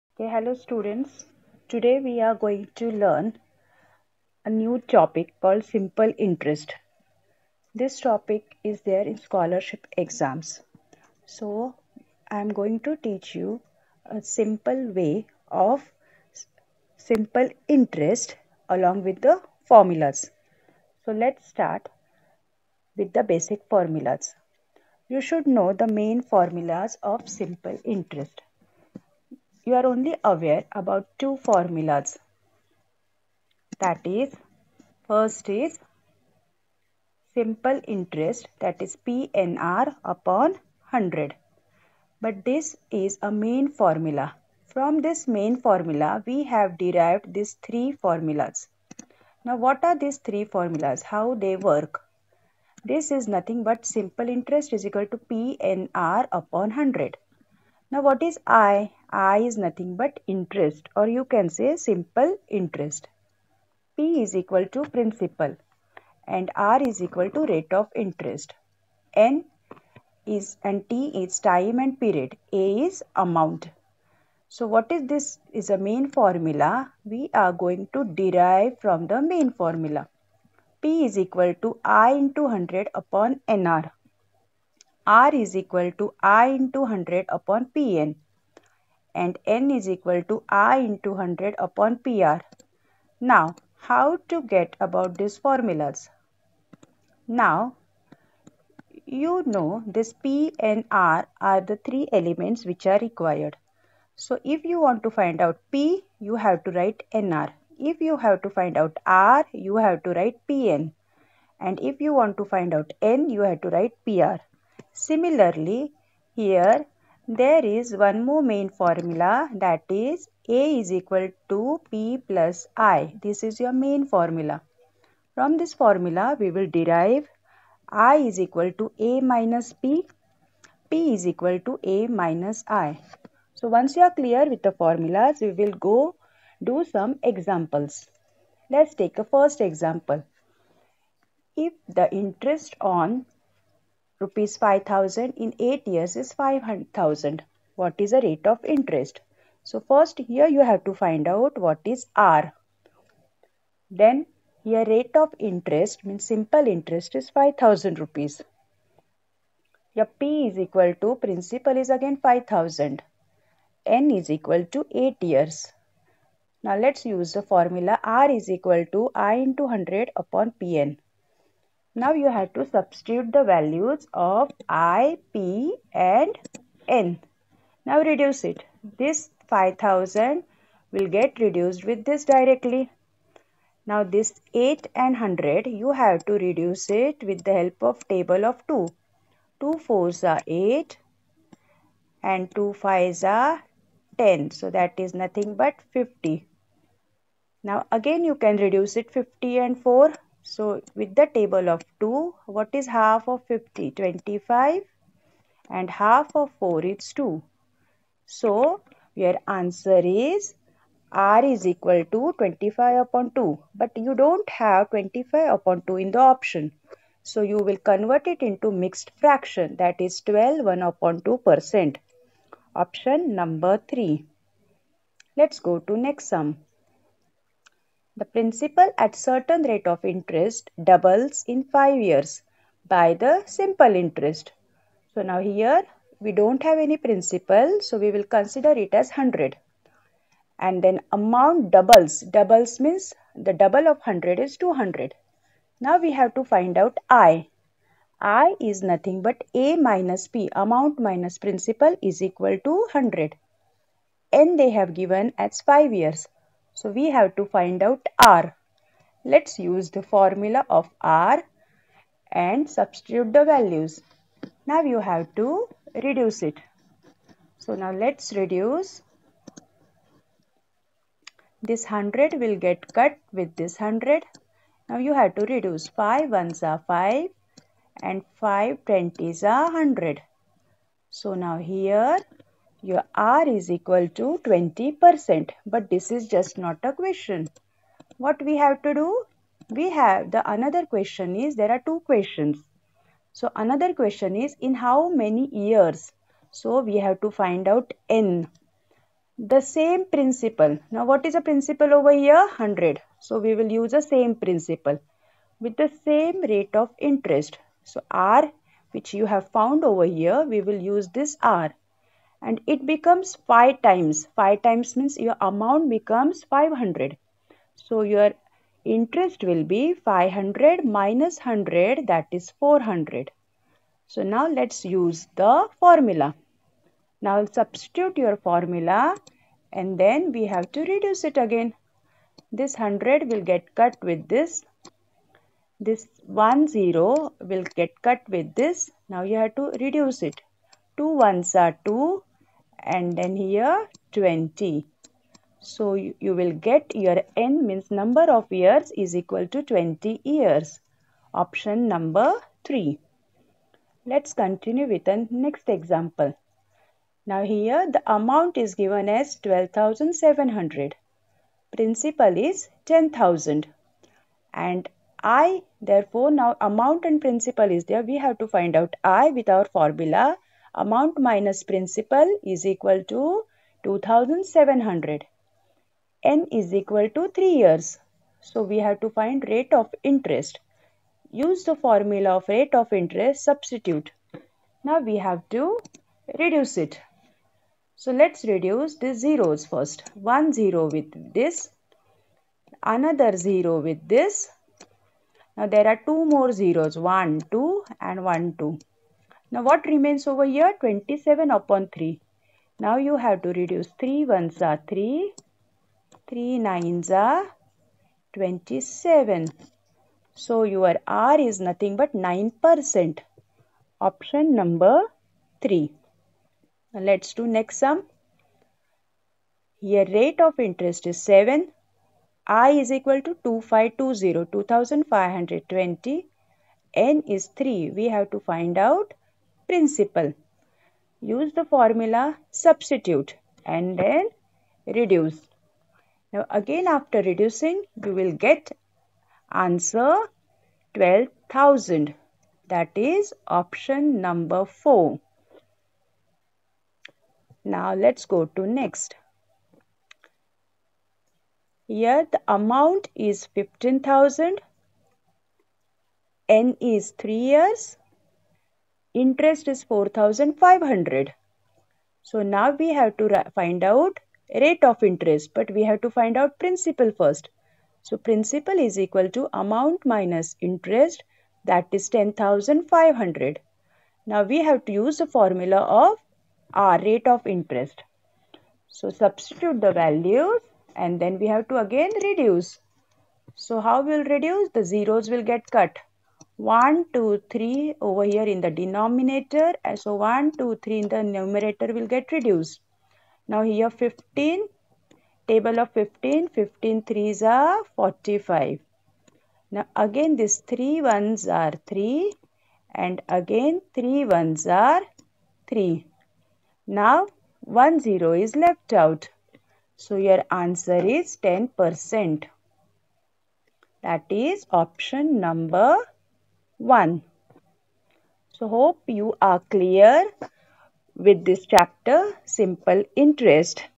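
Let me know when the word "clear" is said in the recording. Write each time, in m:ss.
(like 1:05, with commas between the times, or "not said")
2:14, 8:39.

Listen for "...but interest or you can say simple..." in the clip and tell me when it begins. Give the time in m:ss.
0:59.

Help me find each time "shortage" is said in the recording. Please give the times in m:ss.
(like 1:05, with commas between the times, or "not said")
not said.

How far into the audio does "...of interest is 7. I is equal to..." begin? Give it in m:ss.
7:00.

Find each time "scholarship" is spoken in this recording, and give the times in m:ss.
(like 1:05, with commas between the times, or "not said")
0:09.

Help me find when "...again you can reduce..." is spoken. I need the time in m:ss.
3:17.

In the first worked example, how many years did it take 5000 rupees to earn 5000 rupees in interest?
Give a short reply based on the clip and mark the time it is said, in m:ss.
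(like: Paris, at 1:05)
8 years, at 2:43.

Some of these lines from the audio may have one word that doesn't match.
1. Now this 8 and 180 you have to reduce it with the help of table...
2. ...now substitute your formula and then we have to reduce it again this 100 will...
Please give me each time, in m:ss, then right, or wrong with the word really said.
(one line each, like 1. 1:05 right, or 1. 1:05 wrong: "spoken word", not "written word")
1. 3:03 wrong: "100", not "180"
2. 5:27 right.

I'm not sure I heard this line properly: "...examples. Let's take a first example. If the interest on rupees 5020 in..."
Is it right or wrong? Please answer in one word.
wrong.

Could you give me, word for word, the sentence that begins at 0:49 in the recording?
Now, what are these three formulas?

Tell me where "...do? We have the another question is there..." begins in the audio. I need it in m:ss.
4:48.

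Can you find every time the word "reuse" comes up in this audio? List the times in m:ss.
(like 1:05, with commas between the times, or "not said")
not said.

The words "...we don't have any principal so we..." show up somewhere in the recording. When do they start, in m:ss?
3:56.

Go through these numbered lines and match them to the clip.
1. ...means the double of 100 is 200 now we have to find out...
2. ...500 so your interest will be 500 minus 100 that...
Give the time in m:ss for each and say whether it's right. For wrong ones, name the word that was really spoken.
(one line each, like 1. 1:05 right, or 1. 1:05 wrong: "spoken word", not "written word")
1. 4:02 right
2. 5:16 right.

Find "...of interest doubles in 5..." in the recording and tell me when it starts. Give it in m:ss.
3:49.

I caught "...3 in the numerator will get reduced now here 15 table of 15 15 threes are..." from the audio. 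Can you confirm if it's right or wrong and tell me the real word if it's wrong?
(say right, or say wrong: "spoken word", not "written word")
right.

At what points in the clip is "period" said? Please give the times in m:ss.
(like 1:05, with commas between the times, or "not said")
1:11.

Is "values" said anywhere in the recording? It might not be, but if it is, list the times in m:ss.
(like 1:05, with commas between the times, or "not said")
2:53, 4:23, 7:59.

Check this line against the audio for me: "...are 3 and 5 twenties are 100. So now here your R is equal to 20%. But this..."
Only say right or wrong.
wrong.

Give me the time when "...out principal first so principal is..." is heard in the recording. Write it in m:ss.
7:46.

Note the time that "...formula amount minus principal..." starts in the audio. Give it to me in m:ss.
6:09.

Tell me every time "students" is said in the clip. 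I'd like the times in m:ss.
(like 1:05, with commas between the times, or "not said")
0:00.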